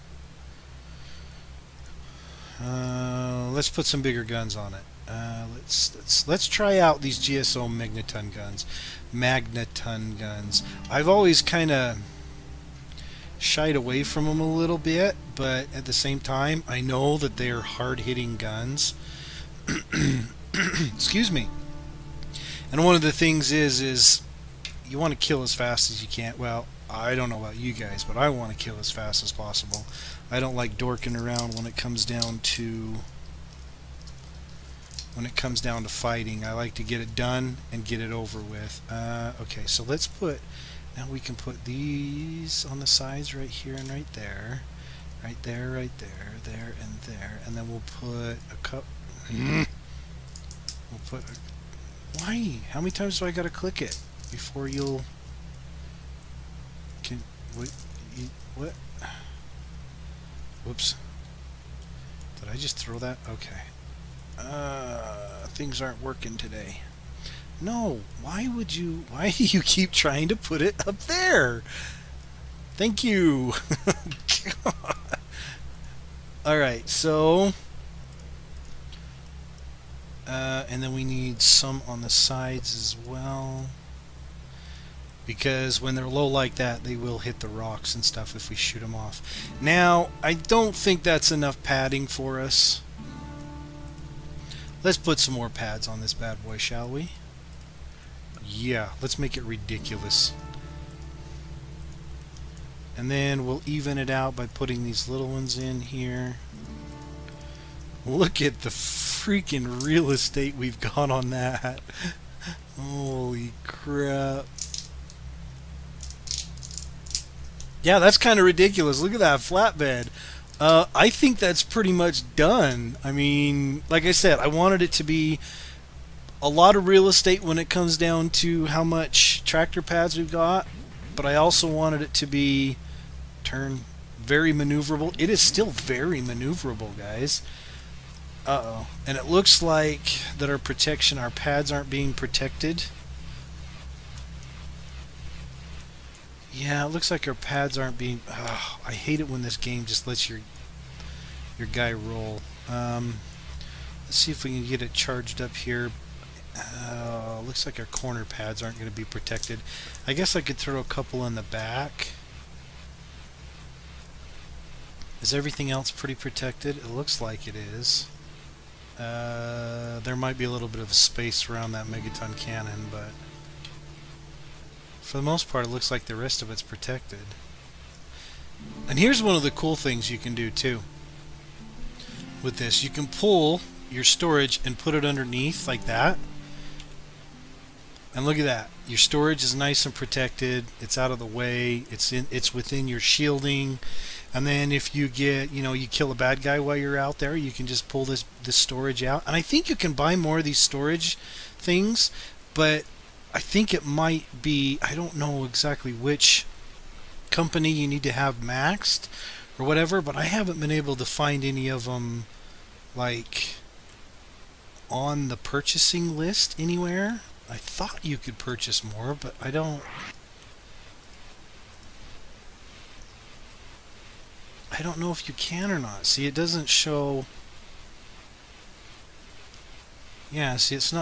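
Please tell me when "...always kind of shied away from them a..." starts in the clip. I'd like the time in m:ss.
0:11.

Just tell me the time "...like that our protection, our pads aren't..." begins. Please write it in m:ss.
2:19.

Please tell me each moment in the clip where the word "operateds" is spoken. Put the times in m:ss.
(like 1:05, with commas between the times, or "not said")
not said.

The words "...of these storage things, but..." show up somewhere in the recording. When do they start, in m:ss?
3:20.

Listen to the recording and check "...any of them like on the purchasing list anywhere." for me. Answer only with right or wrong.
right.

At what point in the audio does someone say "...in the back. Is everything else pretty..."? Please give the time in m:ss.
2:41.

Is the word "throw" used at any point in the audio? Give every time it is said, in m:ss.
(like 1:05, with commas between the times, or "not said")
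1:02, 2:40.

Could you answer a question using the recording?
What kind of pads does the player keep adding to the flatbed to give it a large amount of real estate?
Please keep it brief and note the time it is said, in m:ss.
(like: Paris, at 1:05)
tractor pads, at 2:09.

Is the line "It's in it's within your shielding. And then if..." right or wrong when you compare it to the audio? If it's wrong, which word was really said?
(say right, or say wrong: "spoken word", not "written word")
right.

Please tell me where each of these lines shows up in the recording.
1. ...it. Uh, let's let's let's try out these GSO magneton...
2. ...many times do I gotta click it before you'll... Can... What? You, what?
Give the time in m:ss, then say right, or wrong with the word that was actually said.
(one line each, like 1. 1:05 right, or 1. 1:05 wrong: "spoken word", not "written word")
1. 0:04 right
2. 0:52 right.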